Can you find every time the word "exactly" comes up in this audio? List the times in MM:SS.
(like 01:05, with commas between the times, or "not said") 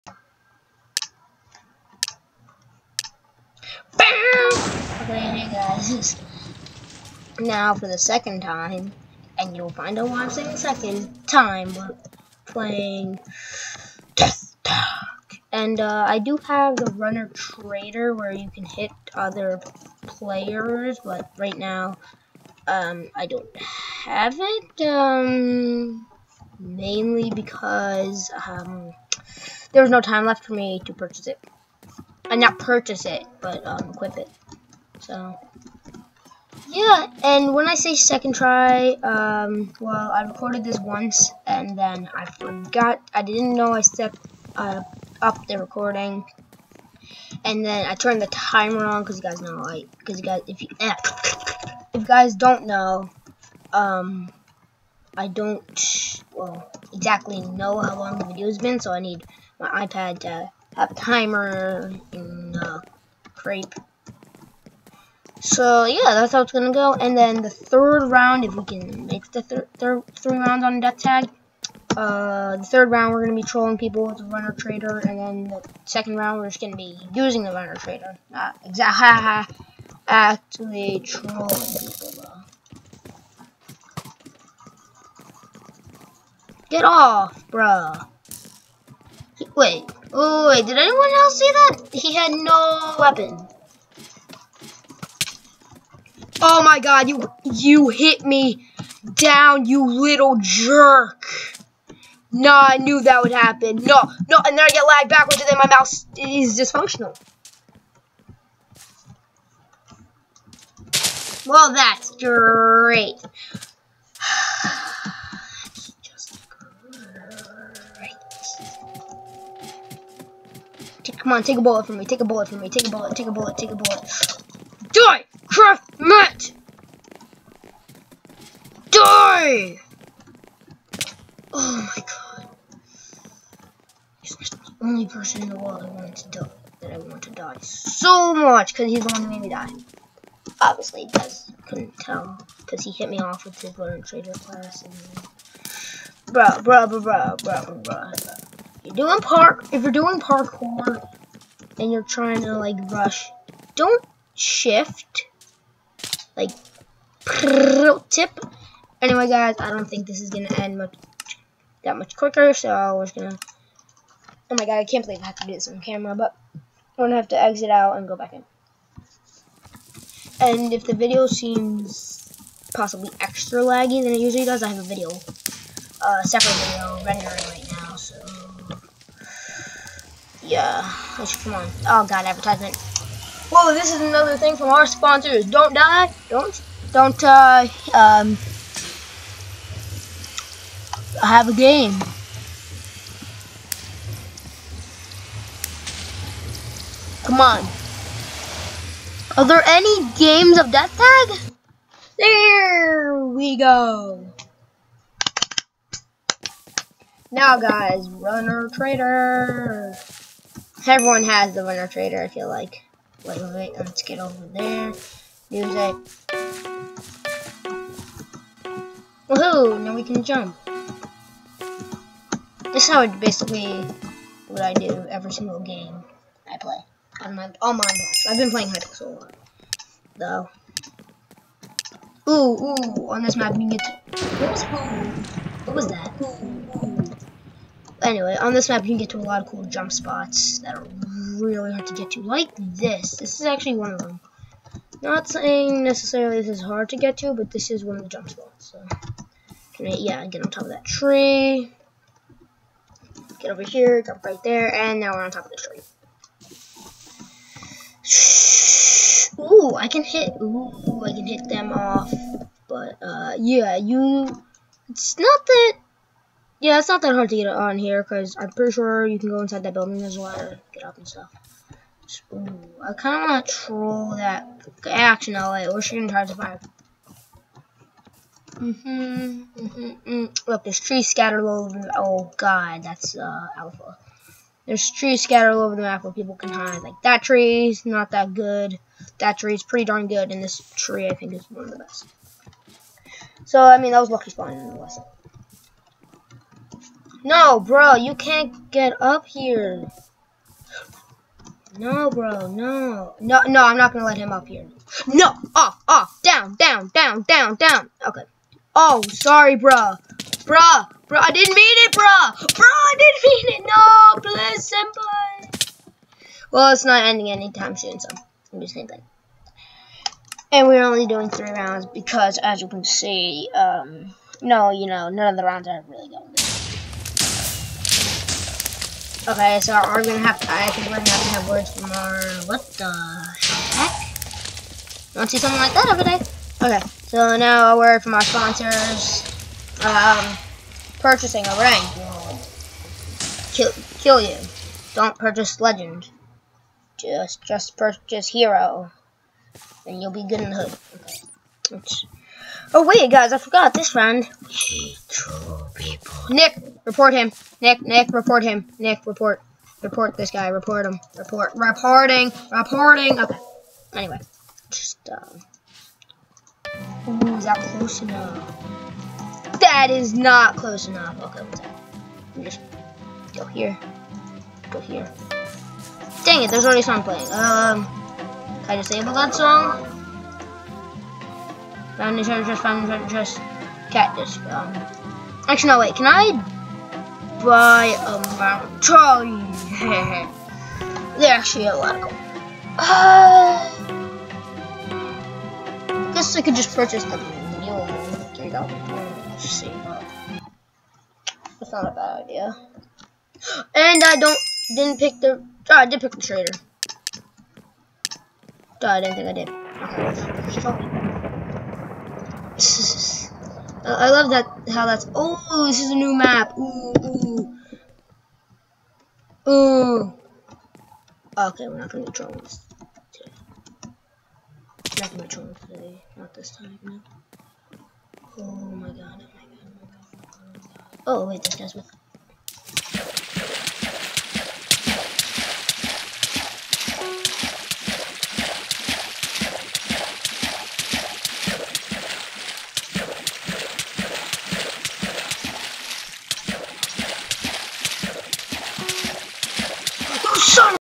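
00:56, 01:18.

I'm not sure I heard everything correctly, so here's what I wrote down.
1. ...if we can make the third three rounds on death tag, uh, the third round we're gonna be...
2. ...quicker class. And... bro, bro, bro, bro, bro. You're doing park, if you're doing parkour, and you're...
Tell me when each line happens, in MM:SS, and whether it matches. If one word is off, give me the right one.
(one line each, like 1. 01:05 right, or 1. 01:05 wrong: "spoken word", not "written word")
1. 01:08 right
2. 02:24 wrong: "trader", not "quicker".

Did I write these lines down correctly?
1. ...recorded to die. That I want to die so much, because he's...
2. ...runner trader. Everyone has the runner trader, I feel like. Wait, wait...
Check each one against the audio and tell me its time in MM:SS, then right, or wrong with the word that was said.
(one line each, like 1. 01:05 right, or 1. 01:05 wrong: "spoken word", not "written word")
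1. 02:15 wrong: "wanted", not "recorded"
2. 03:28 right.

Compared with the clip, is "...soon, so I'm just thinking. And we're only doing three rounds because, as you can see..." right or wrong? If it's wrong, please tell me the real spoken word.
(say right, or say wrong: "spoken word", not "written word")
right.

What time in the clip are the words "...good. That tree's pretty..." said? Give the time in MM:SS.
04:48.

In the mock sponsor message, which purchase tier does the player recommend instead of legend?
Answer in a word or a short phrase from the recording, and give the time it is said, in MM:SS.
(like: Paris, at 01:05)
hero, at 05:48.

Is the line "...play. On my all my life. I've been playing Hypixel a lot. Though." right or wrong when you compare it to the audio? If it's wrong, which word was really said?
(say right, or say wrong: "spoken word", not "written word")
right.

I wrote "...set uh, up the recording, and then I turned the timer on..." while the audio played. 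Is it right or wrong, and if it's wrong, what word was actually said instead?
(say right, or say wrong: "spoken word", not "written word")
right.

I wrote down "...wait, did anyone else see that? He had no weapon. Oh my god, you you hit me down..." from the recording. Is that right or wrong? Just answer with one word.
right.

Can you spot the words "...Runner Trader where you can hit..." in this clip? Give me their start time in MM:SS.
00:16.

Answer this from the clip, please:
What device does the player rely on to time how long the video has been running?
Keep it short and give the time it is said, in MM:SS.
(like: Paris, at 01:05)
iPad, at 00:59.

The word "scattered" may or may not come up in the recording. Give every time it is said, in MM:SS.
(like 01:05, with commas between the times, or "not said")
04:41, 04:45.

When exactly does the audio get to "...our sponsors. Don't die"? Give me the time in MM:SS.
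03:04.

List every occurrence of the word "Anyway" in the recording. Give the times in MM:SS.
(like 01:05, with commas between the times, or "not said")
02:39, 03:58, 06:03.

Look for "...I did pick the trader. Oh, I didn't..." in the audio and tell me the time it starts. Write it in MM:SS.
06:45.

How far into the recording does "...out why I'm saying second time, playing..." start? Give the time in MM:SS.
00:09.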